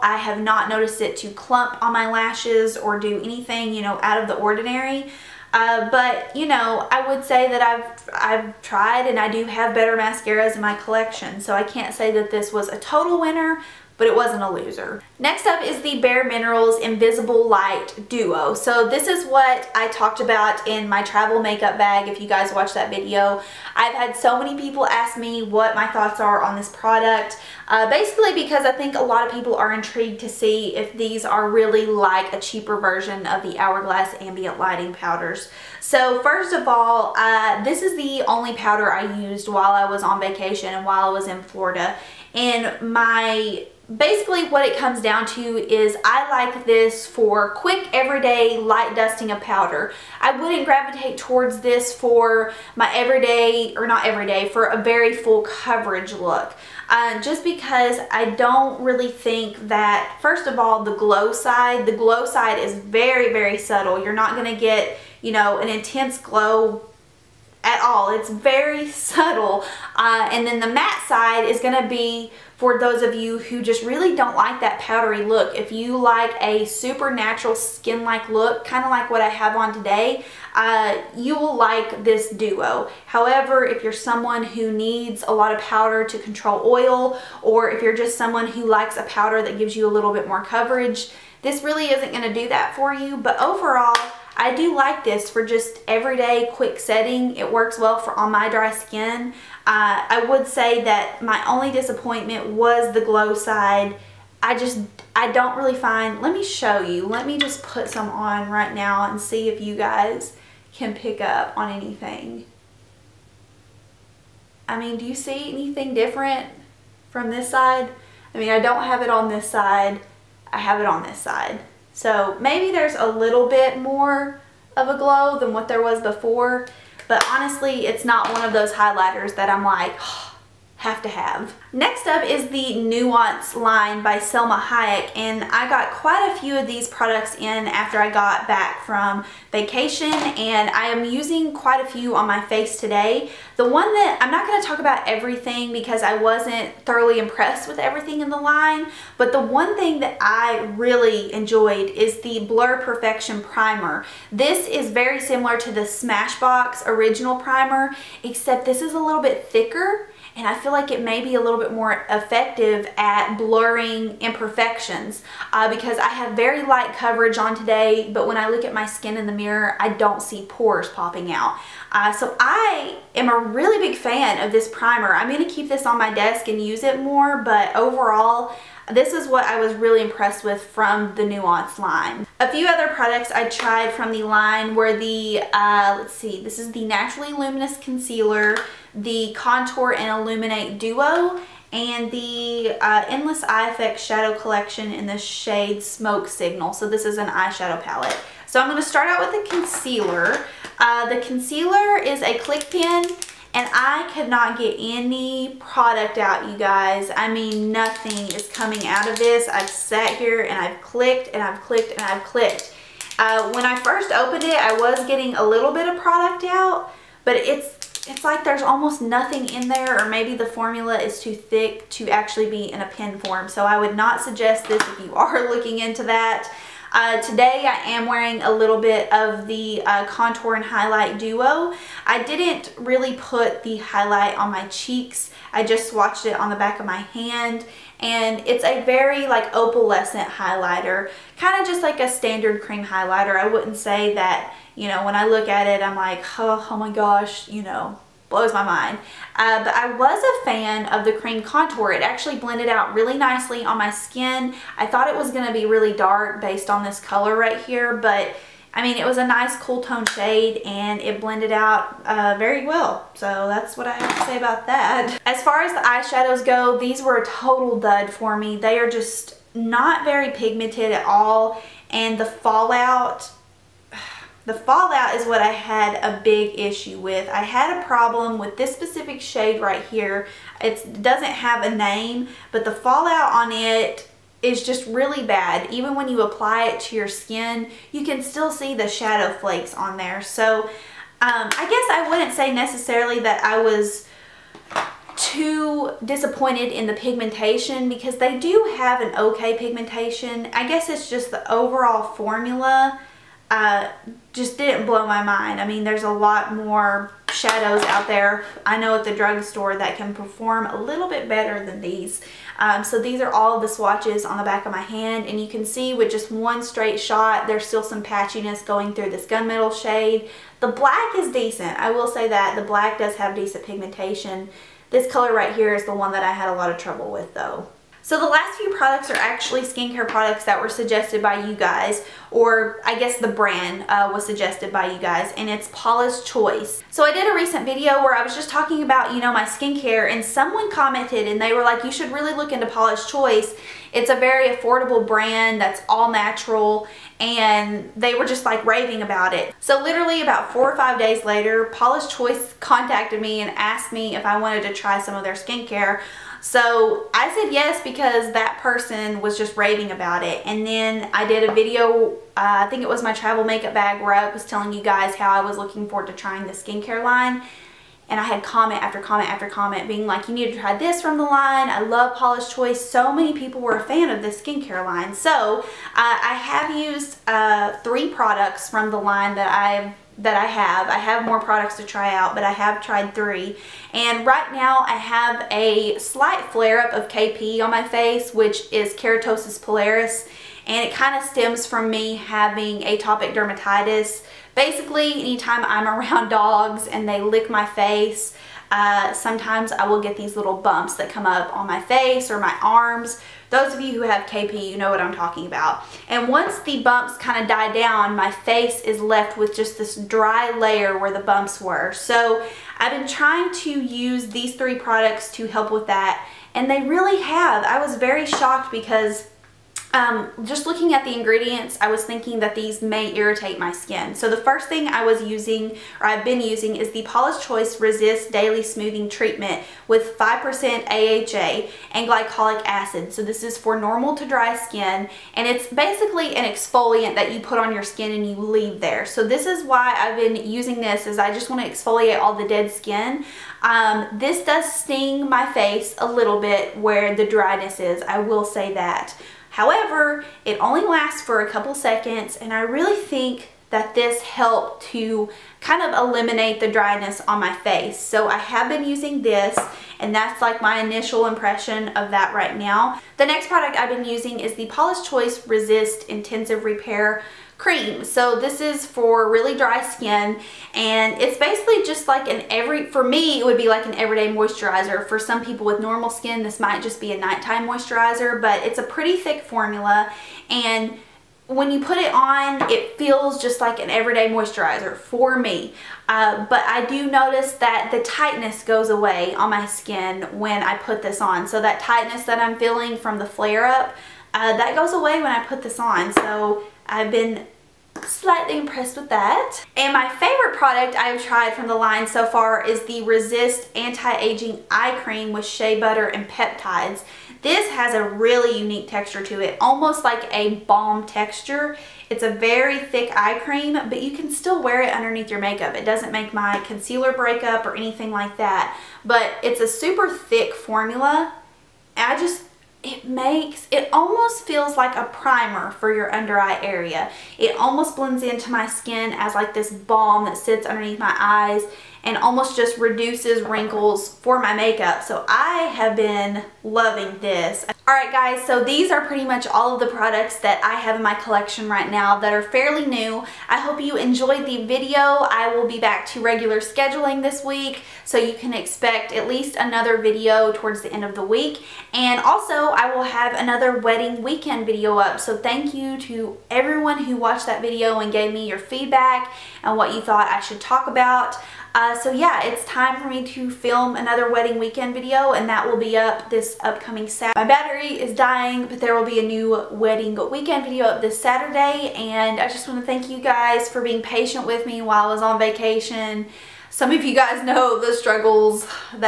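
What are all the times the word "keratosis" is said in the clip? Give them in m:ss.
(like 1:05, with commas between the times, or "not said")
6:28.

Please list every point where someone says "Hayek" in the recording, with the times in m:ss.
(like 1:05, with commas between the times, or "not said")
2:14.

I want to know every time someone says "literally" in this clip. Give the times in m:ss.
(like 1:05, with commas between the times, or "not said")
5:49.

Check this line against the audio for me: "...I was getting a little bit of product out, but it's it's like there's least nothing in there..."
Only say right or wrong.
wrong.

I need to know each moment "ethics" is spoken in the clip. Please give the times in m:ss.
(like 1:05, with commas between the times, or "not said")
not said.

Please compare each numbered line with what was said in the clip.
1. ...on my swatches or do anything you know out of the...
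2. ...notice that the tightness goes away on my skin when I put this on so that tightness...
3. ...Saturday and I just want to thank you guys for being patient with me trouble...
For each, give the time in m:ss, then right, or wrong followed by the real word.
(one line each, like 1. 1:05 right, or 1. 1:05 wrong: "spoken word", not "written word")
1. 0:01 wrong: "lashes", not "swatches"
2. 8:07 right
3. 9:31 wrong: "while", not "trouble".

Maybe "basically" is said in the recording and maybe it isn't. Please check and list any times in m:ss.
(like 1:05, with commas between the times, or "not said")
0:27, 0:43, 6:34, 7:15, 7:51.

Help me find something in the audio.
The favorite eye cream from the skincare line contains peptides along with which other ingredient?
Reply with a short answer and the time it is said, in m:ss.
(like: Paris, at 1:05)
shea butter, at 8:25.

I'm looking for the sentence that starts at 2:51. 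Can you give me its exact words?
Uh, so I am a really big fan of this primer.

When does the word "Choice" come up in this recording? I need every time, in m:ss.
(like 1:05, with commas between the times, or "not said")
5:36, 5:43, 5:52, 6:12, 7:07, 7:45.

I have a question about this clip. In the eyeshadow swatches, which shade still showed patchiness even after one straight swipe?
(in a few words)
gunmetal.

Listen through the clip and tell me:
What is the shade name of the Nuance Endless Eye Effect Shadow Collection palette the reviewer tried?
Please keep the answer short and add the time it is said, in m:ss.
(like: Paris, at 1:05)
Smoke Signal, at 3:15.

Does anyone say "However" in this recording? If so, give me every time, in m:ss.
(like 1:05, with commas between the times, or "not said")
1:23, 7:29.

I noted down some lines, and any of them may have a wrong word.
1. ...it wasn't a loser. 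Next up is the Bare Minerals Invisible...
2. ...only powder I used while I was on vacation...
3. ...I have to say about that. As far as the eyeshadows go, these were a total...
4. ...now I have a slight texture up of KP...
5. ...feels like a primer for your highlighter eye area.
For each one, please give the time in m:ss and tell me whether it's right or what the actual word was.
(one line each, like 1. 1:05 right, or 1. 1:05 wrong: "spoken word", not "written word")
1. 0:14 right
2. 0:38 right
3. 4:23 right
4. 6:24 wrong: "flare", not "texture"
5. 8:44 wrong: "under", not "highlighter".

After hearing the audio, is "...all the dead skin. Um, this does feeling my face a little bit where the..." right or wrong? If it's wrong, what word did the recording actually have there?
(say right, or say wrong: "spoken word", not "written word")
wrong: "sting", not "feeling".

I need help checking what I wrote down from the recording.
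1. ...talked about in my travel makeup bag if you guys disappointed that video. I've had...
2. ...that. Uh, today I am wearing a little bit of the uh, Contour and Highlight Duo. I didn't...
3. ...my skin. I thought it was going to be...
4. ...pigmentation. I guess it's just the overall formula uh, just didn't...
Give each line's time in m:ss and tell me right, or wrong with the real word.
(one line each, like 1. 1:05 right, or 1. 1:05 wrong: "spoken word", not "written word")
1. 0:19 wrong: "watched", not "disappointed"
2. 3:46 right
3. 4:13 right
4. 4:59 right.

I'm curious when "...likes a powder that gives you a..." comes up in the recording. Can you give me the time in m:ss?
1:28.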